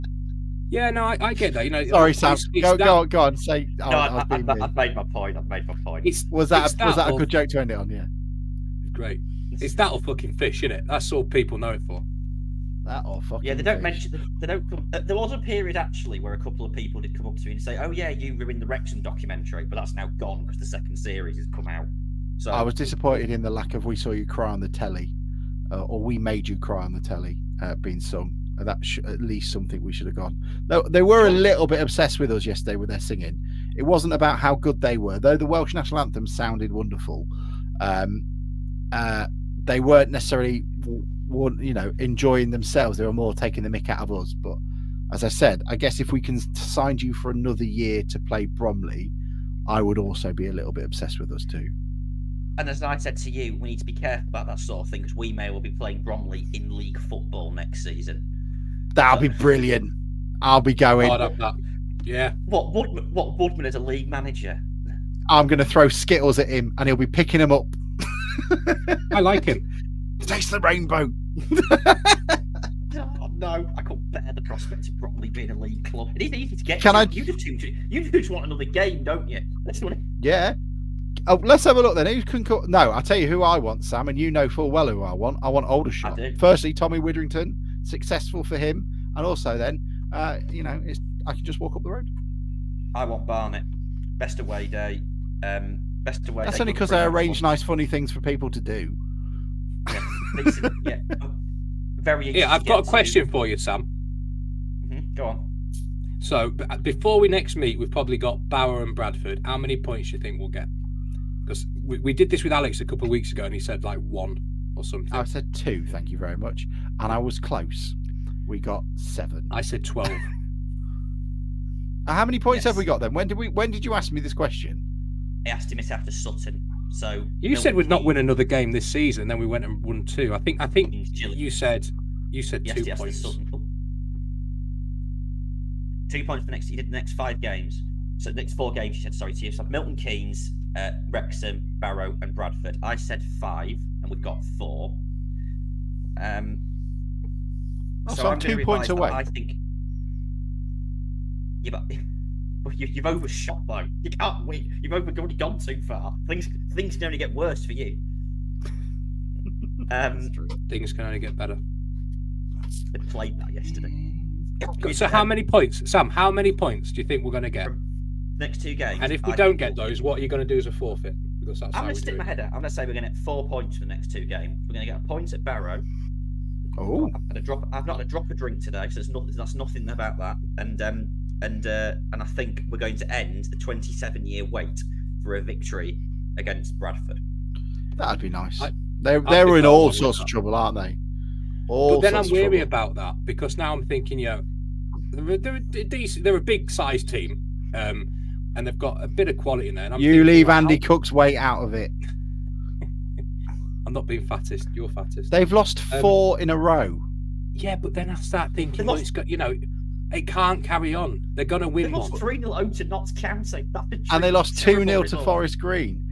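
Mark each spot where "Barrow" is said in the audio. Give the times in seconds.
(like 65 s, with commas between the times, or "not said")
108 s, 141 s, 175 s.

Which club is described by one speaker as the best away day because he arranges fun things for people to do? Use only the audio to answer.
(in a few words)
Barnet.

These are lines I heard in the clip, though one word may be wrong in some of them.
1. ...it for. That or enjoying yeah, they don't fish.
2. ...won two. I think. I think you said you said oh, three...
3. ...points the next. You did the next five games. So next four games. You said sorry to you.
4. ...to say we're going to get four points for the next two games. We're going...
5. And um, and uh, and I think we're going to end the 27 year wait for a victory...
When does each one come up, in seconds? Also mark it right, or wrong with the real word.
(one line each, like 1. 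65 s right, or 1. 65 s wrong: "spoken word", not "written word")
1. 11 s wrong: "fucking", not "enjoying"
2. 129 s wrong: "two", not "three"
3. 136 s right
4. 172 s right
5. 180 s right.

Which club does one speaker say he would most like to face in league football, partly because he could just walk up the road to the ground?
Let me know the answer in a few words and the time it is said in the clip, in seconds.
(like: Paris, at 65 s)
Aldershot, at 85 s.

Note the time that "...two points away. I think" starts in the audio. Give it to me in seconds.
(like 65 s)
148 s.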